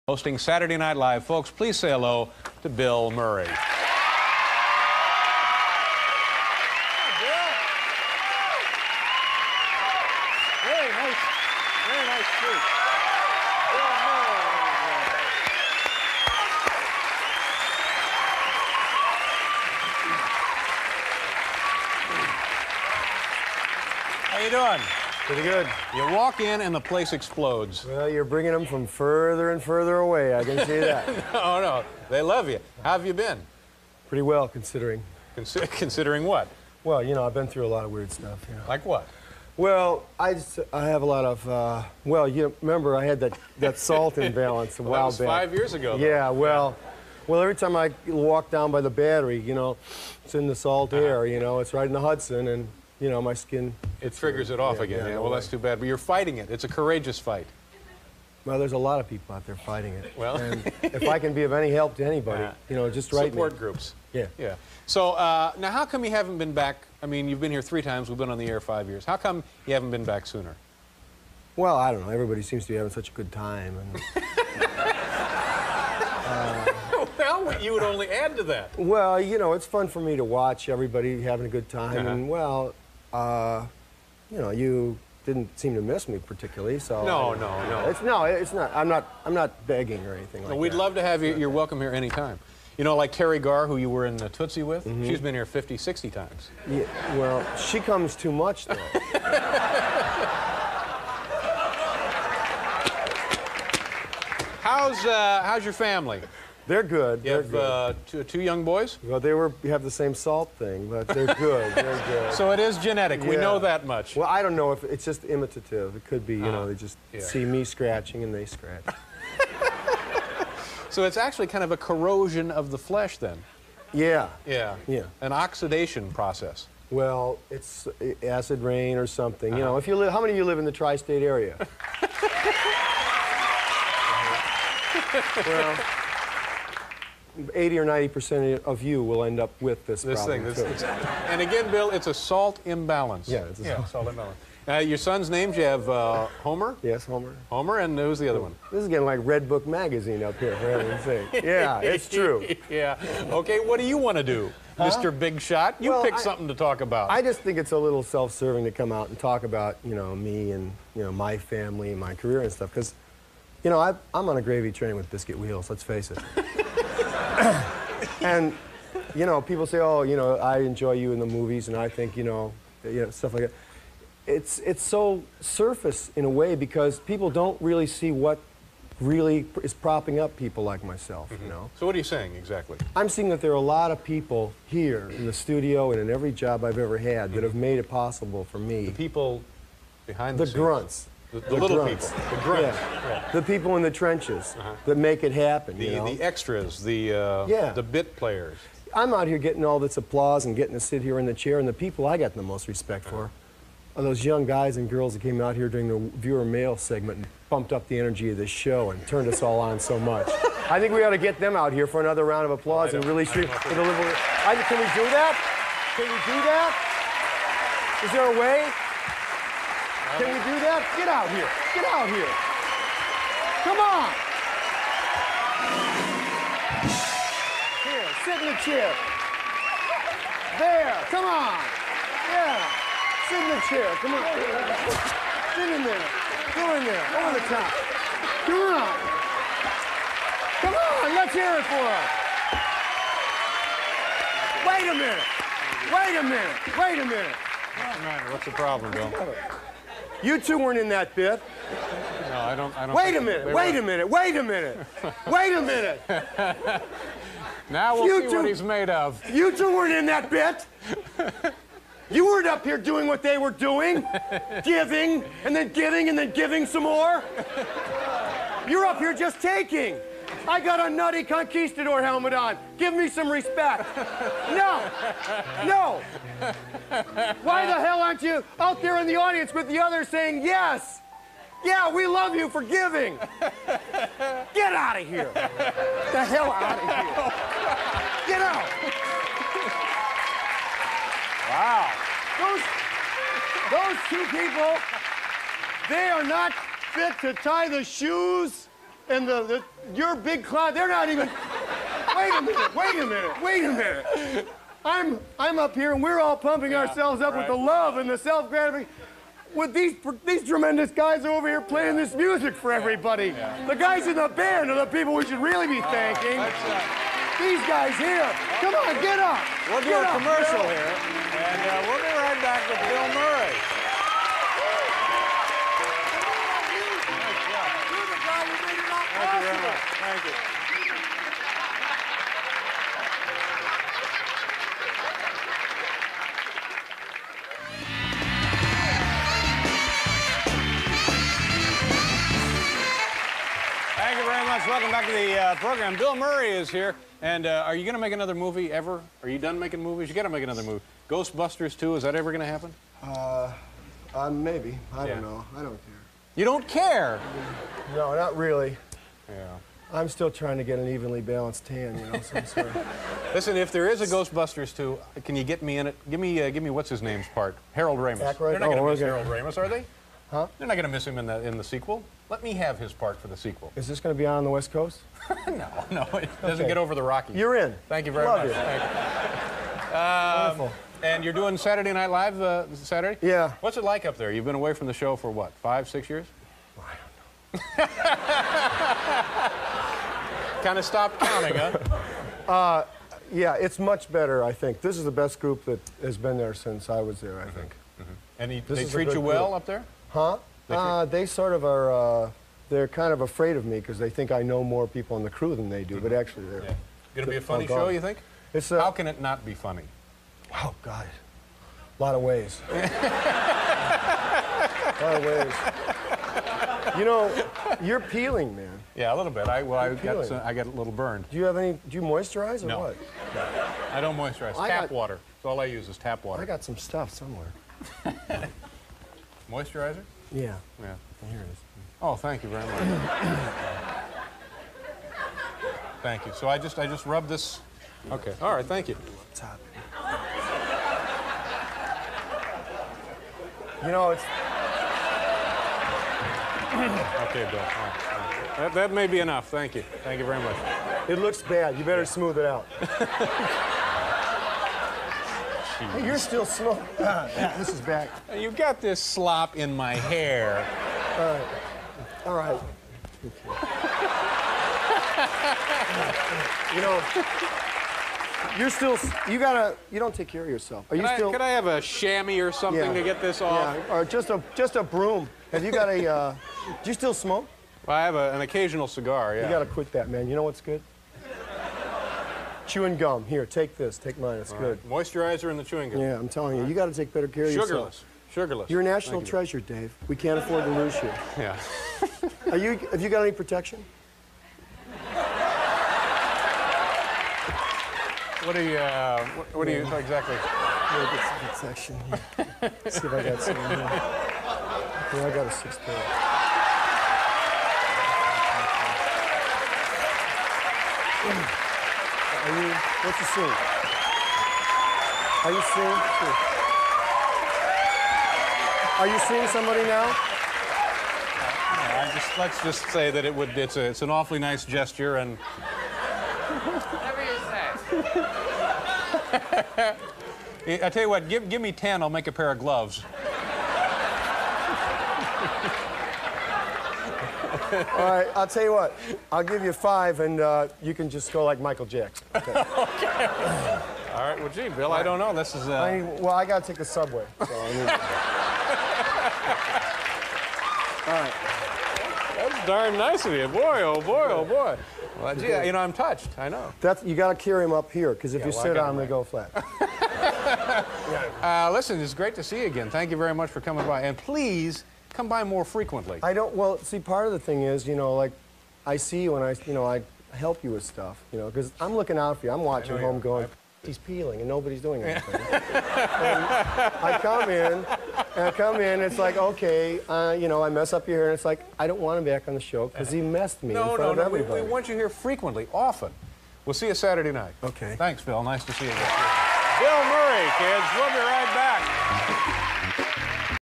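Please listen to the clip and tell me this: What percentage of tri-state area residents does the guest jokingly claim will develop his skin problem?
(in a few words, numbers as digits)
80 or 90 percent.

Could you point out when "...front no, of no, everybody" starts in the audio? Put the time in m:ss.
9:43.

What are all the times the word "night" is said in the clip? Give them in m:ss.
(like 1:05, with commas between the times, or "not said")
0:00, 6:21, 9:47.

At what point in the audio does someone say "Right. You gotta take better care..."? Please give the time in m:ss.
8:06.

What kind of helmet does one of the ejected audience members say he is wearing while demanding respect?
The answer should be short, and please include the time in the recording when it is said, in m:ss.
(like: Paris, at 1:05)
conquistador helmet, at 4:31.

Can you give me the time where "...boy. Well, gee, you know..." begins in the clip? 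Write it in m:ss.
9:14.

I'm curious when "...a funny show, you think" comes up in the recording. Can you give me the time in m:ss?
6:47.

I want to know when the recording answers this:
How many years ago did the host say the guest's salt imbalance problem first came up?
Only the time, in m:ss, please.
0:45.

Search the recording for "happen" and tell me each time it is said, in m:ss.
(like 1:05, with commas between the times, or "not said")
3:15, 5:52.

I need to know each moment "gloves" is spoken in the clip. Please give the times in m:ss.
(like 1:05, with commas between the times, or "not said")
8:52.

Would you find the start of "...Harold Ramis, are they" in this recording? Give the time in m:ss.
6:09.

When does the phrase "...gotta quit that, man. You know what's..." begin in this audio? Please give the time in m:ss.
7:59.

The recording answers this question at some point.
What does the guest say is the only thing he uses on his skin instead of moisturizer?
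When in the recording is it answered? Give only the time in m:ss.
7:05.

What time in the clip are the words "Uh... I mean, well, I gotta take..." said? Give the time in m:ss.
9:05.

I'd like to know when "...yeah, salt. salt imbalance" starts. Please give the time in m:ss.
2:23.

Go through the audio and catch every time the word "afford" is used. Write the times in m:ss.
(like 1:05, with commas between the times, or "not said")
8:10.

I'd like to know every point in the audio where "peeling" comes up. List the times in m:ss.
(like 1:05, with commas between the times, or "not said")
6:58, 9:33.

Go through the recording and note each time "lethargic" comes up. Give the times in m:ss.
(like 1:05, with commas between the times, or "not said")
not said.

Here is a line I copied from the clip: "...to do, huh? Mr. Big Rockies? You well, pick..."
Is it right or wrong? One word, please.
wrong.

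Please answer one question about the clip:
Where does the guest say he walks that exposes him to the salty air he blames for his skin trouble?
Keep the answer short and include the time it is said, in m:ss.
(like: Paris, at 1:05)
The Battery, at 0:48.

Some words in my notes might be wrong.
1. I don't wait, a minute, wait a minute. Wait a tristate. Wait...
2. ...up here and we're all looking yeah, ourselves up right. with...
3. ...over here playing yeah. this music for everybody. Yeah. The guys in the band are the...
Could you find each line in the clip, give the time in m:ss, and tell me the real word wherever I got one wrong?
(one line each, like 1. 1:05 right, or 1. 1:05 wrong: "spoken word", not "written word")
1. 4:12 wrong: "minute", not "tristate"
2. 5:05 wrong: "pumping", not "looking"
3. 5:11 right.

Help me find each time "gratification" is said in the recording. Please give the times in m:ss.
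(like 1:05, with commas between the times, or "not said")
5:08.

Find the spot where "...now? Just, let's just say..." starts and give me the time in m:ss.
8:39.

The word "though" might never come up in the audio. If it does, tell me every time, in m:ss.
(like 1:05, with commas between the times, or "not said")
0:45, 1:38.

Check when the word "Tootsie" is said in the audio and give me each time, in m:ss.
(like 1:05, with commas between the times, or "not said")
1:34.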